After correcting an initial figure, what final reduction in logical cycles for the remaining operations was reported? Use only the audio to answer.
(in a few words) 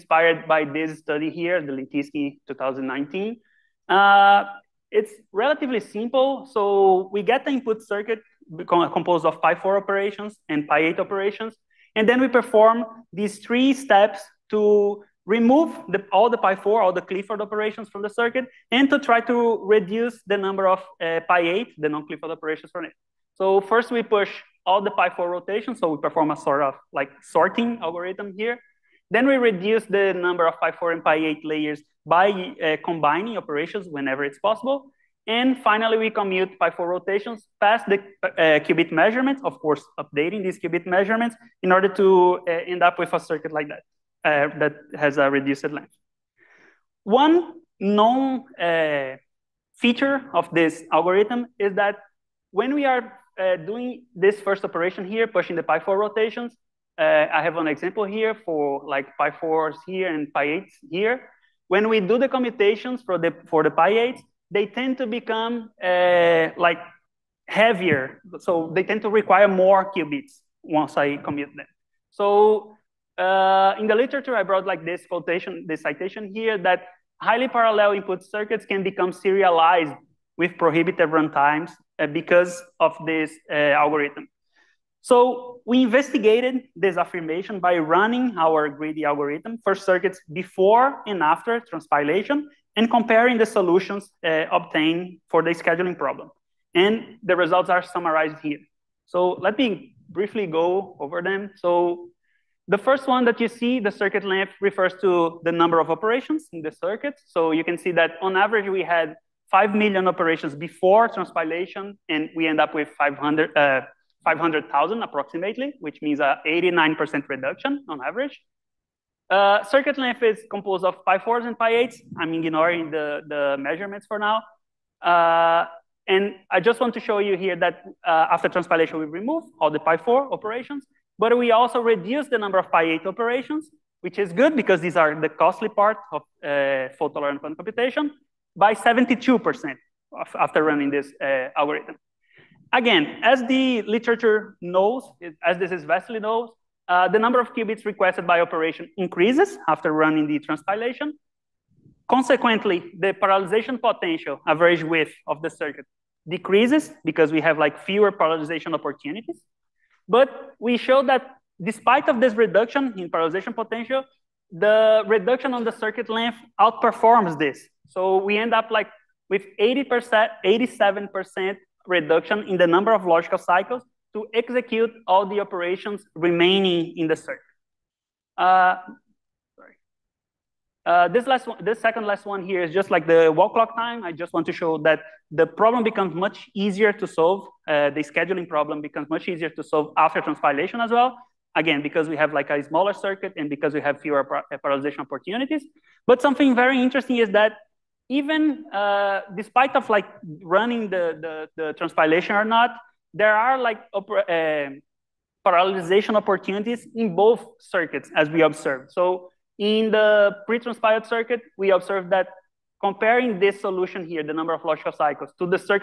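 87%.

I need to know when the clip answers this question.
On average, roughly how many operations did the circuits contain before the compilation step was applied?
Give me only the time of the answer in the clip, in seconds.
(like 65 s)
109 s.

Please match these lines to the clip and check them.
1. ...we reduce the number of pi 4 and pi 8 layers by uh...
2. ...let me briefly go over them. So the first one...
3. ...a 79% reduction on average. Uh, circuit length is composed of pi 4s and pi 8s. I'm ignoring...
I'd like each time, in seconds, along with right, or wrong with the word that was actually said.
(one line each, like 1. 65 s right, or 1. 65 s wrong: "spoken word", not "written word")
1. 29 s right
2. 99 s right
3. 116 s wrong: "89", not "79".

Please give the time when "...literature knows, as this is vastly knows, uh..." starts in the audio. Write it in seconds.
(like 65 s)
143 s.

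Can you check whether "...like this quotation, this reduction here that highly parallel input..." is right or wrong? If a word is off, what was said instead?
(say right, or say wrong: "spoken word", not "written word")
wrong: "citation", not "reduction".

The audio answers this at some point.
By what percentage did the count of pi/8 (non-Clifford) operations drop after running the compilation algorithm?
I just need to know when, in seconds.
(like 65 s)
138 s.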